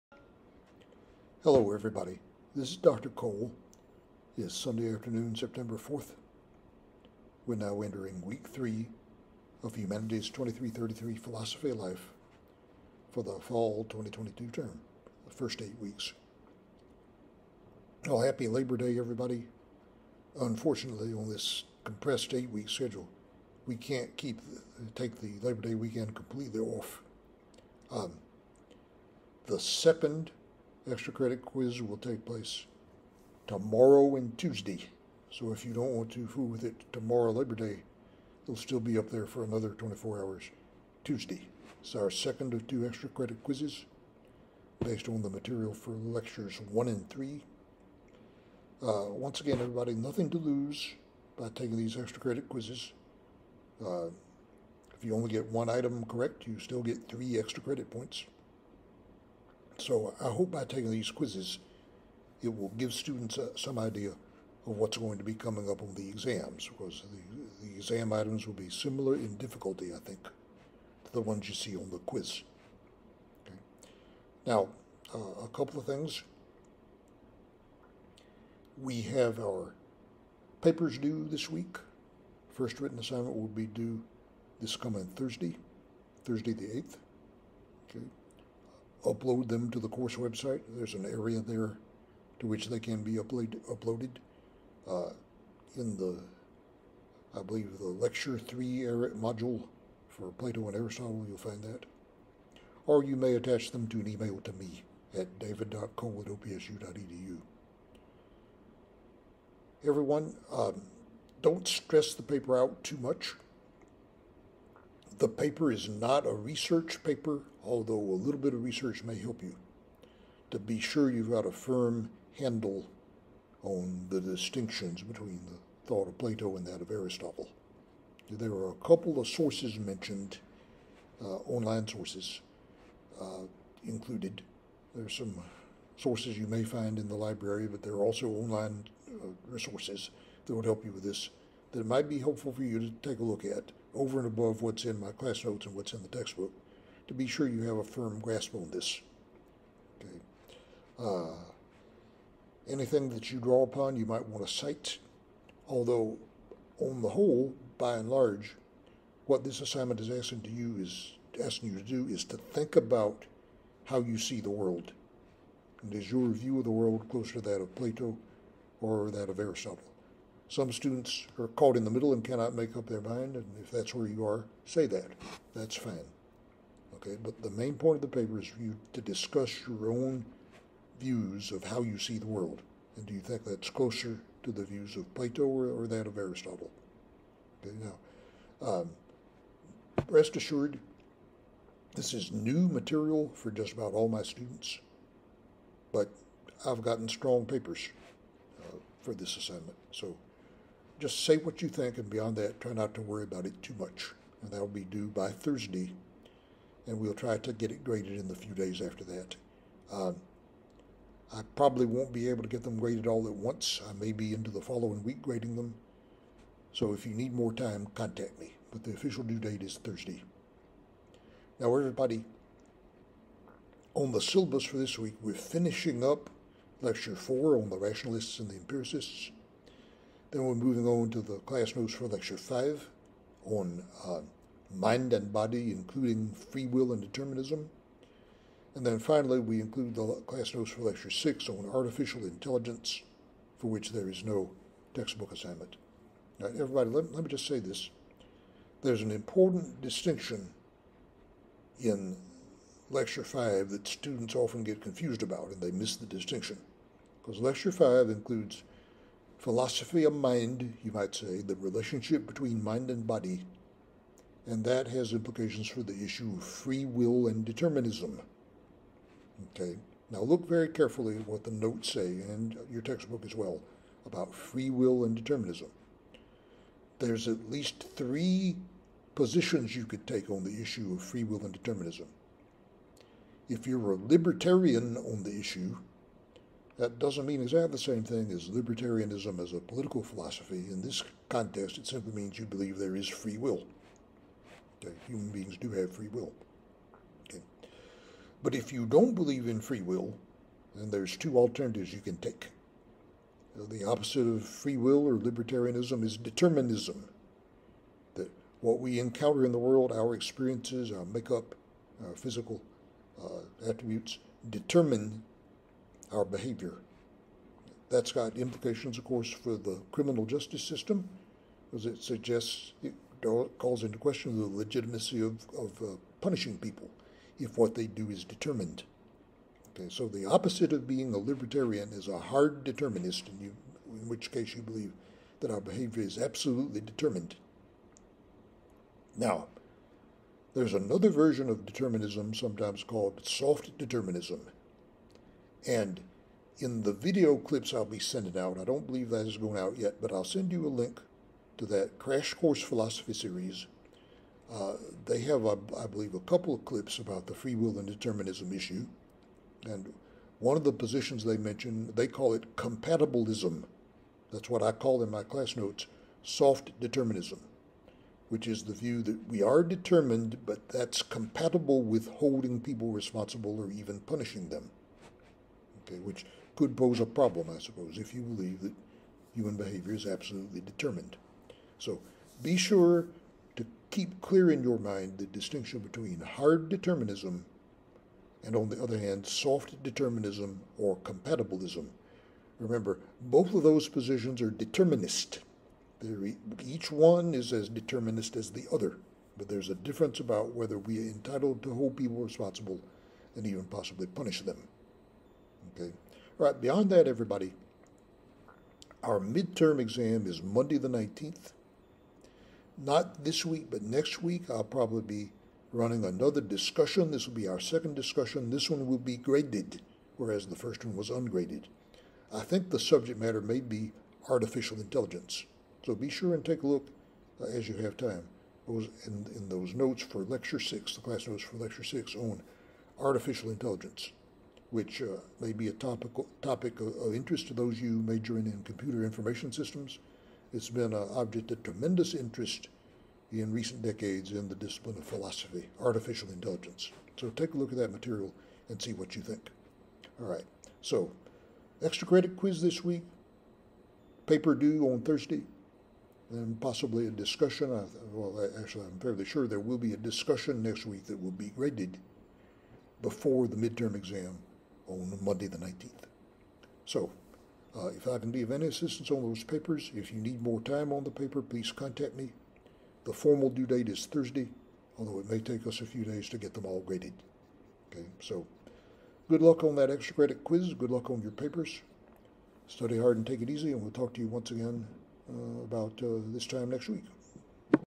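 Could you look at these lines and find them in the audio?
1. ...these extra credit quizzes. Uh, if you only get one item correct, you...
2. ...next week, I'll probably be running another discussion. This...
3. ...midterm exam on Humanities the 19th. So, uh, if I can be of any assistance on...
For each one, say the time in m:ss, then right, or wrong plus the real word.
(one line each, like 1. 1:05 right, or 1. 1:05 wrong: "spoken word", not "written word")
1. 0:51 right
2. 6:53 right
3. 7:43 wrong: "Monday", not "Humanities".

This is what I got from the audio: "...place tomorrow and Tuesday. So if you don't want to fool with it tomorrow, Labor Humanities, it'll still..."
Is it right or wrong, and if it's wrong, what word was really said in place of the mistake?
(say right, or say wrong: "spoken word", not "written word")
wrong: "Day", not "Humanities".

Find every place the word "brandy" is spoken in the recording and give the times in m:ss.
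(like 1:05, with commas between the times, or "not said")
not said.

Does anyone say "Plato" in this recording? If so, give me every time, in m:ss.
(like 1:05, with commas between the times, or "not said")
1:40, 2:06, 2:47, 3:05.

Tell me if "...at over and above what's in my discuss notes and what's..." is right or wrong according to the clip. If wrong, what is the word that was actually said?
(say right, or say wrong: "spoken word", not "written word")
wrong: "class", not "discuss".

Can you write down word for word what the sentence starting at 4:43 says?
If you're a libertarian on the issue, that doesn't mean exactly the same thing as libertarianism as a political philosophy.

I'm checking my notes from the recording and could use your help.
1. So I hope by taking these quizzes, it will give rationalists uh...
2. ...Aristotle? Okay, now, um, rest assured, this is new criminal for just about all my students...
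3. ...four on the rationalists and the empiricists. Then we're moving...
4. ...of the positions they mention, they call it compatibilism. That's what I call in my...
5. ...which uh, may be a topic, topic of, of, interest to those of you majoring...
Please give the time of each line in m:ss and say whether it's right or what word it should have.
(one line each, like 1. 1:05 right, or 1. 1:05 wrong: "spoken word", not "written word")
1. 0:59 wrong: "students", not "rationalists"
2. 3:06 wrong: "material", not "criminal"
3. 3:47 right
4. 6:00 right
5. 7:14 right.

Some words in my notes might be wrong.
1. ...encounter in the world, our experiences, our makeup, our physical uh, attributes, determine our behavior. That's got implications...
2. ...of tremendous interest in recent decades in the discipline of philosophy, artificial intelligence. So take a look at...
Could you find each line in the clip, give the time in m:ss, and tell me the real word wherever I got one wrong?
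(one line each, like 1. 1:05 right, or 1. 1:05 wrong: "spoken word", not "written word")
1. 5:08 right
2. 7:21 right.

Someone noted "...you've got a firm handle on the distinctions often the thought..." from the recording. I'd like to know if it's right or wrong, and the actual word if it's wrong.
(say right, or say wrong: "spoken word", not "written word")
wrong: "between", not "often".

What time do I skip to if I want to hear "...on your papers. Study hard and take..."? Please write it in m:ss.
8:01.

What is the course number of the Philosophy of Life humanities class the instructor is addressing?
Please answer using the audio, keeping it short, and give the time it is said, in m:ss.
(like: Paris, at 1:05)
2333, at 0:10.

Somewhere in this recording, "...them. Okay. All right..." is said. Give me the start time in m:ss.
6:44.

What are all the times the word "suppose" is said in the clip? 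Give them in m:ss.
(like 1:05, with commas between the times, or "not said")
6:17.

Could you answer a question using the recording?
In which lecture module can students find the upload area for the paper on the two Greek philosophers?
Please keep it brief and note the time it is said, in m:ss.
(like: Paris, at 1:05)
Lecture 3, at 1:37.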